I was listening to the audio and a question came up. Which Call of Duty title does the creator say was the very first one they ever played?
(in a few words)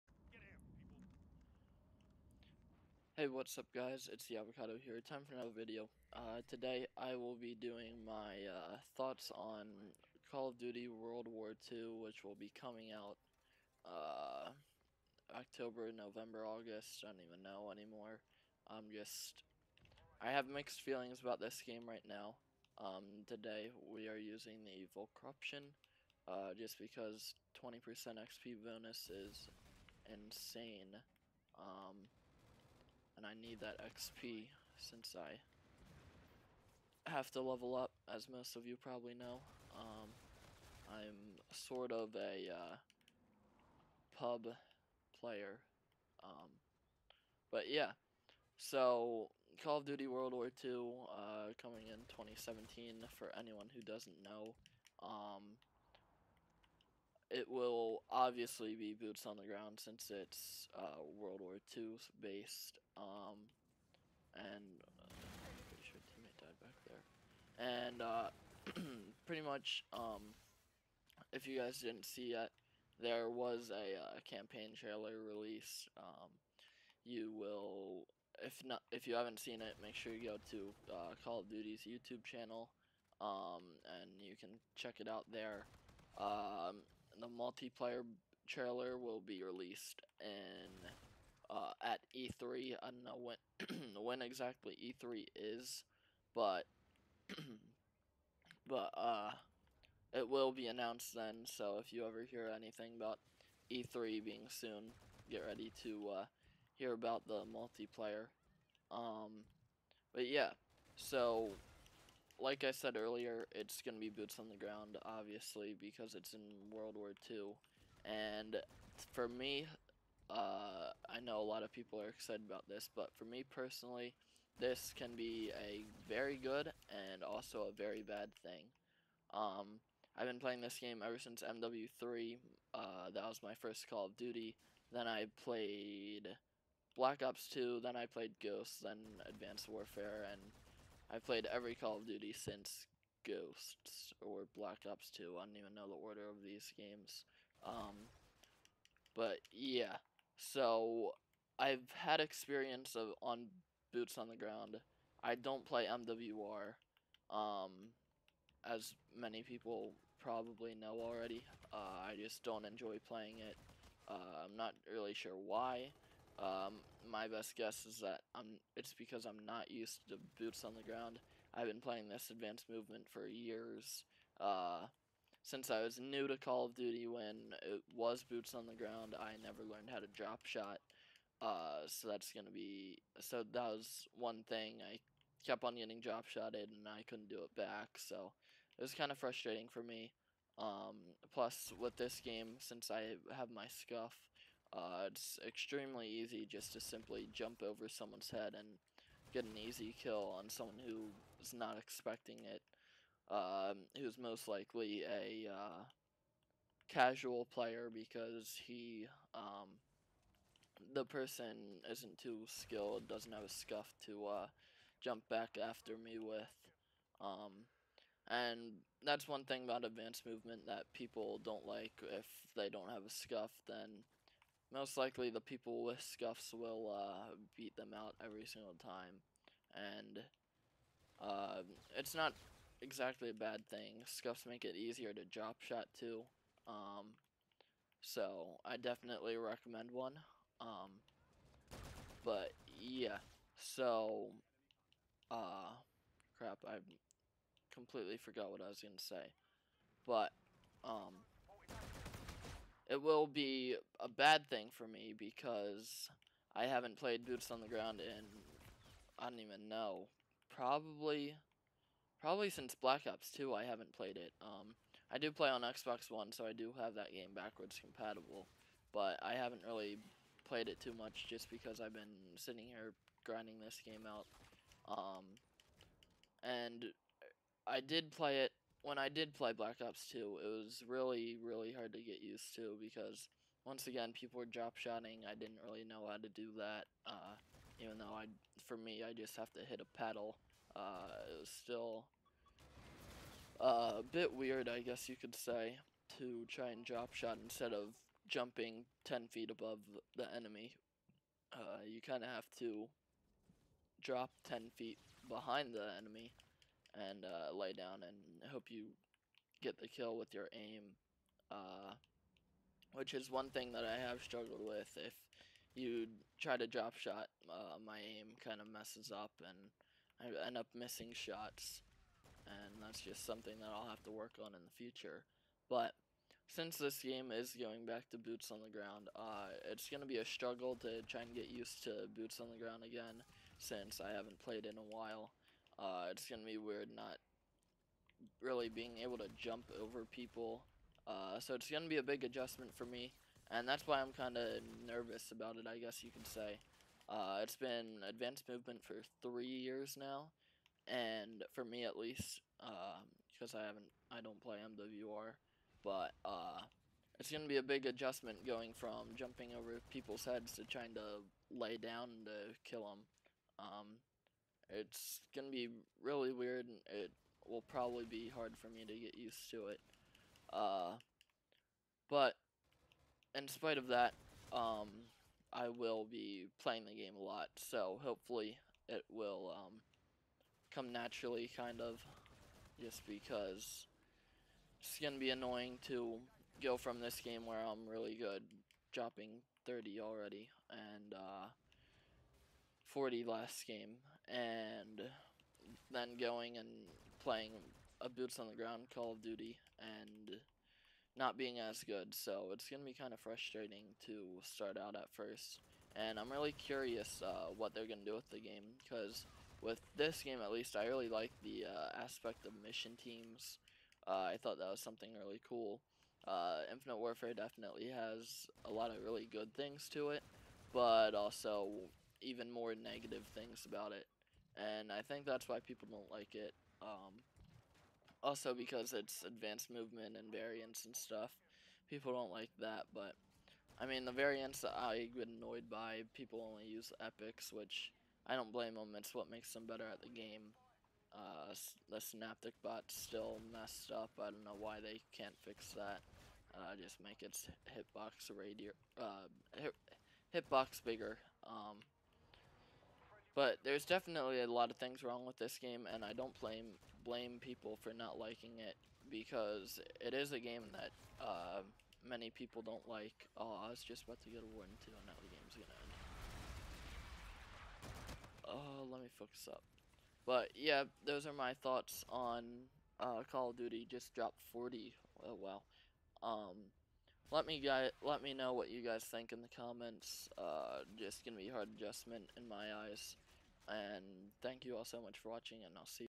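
MW3.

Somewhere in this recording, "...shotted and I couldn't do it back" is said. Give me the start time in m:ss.
3:06.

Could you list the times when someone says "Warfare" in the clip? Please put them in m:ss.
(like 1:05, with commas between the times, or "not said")
2:19, 6:56.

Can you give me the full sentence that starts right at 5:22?
And that's just something that I'll have to work on in the future.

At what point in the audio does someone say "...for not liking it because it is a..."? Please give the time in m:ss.
7:37.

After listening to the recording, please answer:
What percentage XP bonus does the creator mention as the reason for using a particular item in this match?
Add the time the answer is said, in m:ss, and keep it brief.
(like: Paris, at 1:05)
20%, at 0:27.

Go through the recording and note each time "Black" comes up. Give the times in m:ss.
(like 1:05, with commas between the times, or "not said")
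2:16, 2:24, 4:22, 4:39.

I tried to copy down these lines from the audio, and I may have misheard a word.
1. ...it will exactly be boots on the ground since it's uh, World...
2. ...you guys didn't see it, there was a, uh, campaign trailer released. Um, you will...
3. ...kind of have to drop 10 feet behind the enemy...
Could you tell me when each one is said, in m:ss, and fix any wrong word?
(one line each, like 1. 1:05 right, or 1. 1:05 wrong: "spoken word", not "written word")
1. 0:57 wrong: "obviously", not "exactly"
2. 1:11 right
3. 5:02 right.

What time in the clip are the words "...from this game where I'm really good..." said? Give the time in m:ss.
6:26.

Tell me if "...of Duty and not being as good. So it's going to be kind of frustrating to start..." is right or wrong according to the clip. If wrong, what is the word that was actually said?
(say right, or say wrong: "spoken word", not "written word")
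right.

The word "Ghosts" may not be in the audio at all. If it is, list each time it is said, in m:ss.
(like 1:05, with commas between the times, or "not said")
2:18, 2:23.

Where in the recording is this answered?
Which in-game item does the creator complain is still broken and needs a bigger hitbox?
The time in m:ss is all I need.
7:21.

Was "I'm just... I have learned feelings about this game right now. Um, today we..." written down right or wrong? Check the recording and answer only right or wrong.
wrong.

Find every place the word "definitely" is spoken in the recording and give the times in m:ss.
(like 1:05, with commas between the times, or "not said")
3:58, 6:57, 7:33.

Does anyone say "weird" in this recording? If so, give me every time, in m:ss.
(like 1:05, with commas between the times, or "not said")
4:54, 5:36, 6:06.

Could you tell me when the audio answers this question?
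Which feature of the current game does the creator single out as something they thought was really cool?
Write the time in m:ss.
6:52.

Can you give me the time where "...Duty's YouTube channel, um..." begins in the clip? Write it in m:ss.
1:21.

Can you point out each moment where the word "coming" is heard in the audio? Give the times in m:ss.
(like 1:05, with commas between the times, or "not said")
0:12, 0:51.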